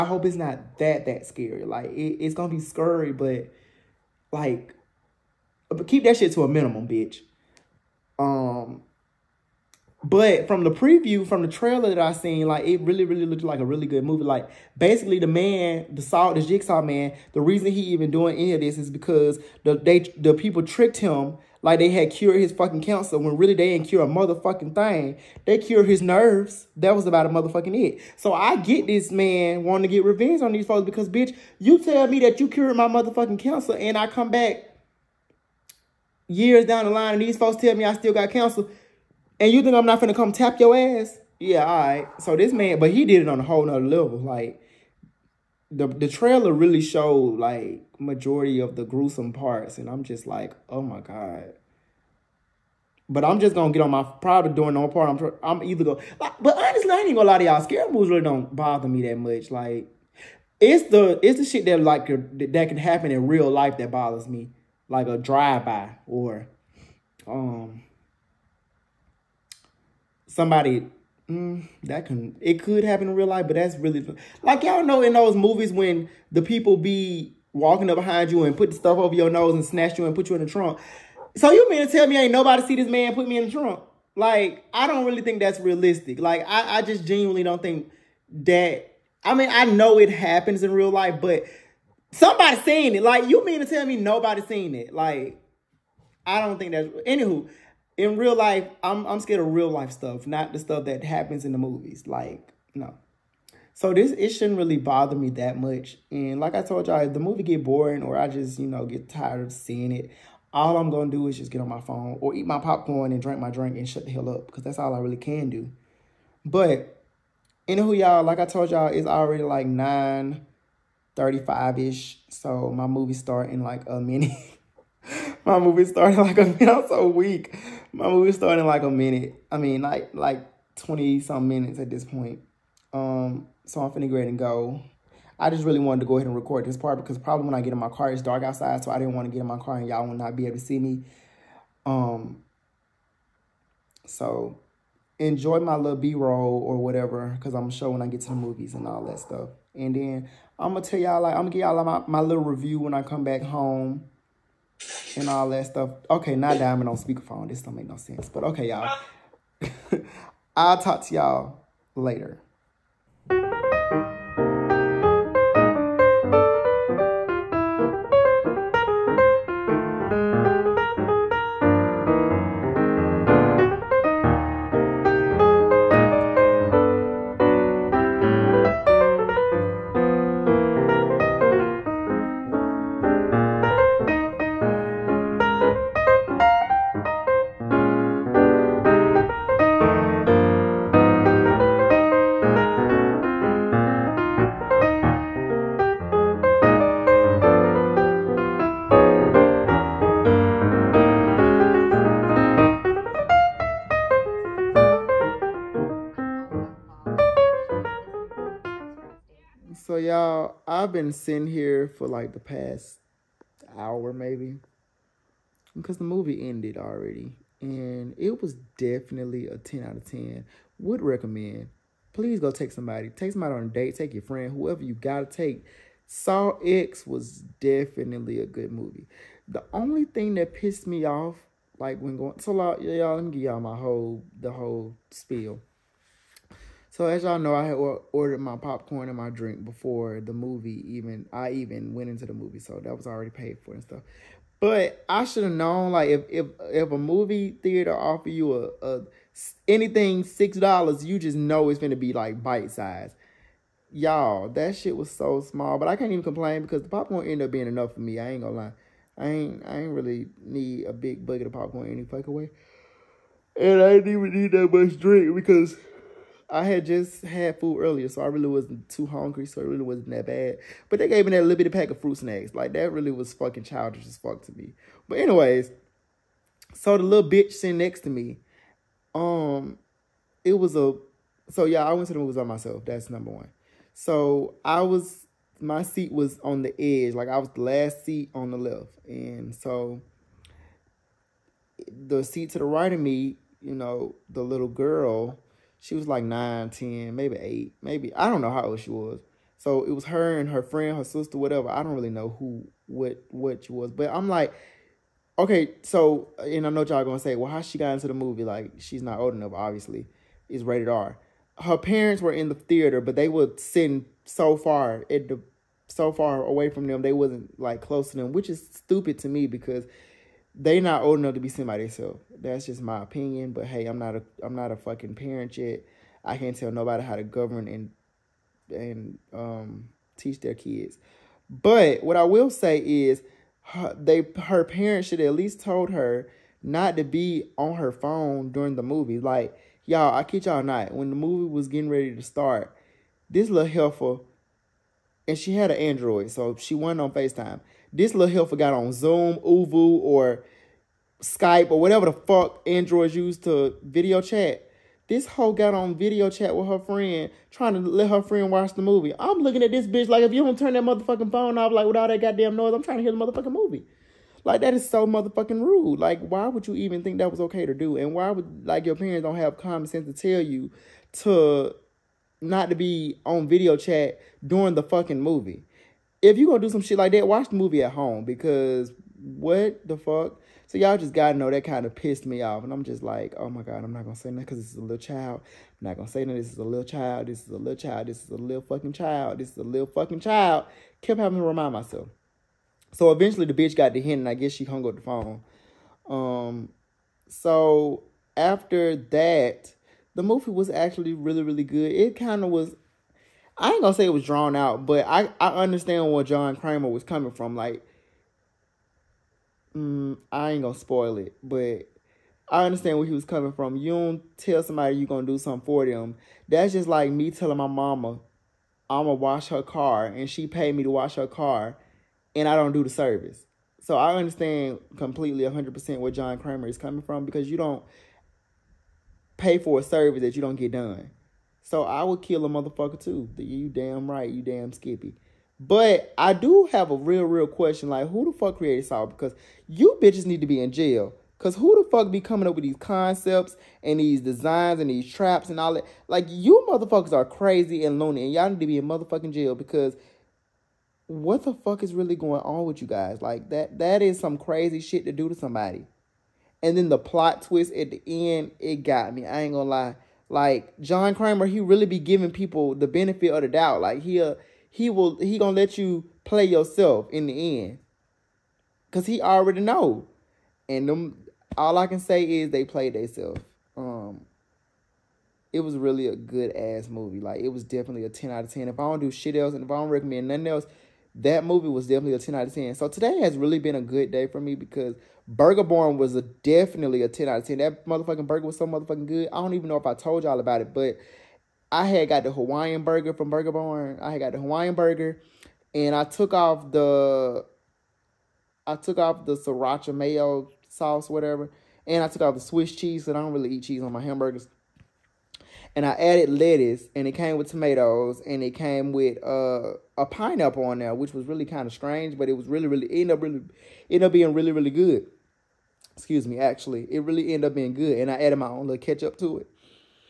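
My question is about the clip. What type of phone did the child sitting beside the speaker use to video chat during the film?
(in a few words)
Android.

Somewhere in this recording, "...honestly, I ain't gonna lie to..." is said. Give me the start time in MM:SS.
00:56.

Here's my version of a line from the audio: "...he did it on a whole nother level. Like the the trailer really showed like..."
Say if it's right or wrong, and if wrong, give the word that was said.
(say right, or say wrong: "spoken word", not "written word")
right.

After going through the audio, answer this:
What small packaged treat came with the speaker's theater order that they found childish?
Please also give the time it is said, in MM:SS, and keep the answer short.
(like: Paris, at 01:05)
Fruit snacks, at 04:32.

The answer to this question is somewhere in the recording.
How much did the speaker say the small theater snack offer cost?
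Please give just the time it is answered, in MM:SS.
04:10.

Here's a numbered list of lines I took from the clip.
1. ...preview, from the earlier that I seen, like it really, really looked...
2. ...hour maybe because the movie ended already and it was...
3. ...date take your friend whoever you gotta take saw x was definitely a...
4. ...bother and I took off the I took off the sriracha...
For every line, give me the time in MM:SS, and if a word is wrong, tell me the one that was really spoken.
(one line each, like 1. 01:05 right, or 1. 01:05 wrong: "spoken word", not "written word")
1. 00:10 wrong: "trailer", not "earlier"
2. 03:33 right
3. 03:43 right
4. 08:14 wrong: "burger", not "bother".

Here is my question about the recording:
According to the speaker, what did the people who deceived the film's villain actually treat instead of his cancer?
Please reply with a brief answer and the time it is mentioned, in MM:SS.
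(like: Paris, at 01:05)
His nerves, at 00:25.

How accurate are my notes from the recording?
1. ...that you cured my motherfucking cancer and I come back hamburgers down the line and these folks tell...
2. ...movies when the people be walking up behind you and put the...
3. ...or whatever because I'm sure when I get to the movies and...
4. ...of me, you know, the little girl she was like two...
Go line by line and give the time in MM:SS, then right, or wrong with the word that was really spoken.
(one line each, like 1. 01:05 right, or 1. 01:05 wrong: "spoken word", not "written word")
1. 00:32 wrong: "years", not "hamburgers"
2. 01:15 right
3. 02:26 right
4. 04:52 wrong: "nine", not "two".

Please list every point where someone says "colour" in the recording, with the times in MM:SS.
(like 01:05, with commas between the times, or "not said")
not said.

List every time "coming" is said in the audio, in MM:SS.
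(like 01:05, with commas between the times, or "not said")
06:47, 06:53, 07:06, 07:22.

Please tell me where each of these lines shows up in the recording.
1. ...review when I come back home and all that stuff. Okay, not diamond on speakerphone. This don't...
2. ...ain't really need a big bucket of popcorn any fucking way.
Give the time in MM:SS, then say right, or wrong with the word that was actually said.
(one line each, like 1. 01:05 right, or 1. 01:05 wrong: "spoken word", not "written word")
1. 02:32 right
2. 04:19 right.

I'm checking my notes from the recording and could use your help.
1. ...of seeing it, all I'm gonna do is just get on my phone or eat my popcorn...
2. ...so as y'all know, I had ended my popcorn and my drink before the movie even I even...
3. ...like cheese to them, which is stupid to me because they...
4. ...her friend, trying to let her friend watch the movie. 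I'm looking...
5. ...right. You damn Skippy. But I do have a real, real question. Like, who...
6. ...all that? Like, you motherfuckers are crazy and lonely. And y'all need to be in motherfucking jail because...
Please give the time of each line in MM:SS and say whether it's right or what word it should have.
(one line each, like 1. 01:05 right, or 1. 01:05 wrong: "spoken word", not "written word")
1. 01:49 right
2. 03:56 wrong: "ordered", not "ended"
3. 05:17 wrong: "close", not "cheese"
4. 05:56 right
5. 07:14 right
6. 07:25 right.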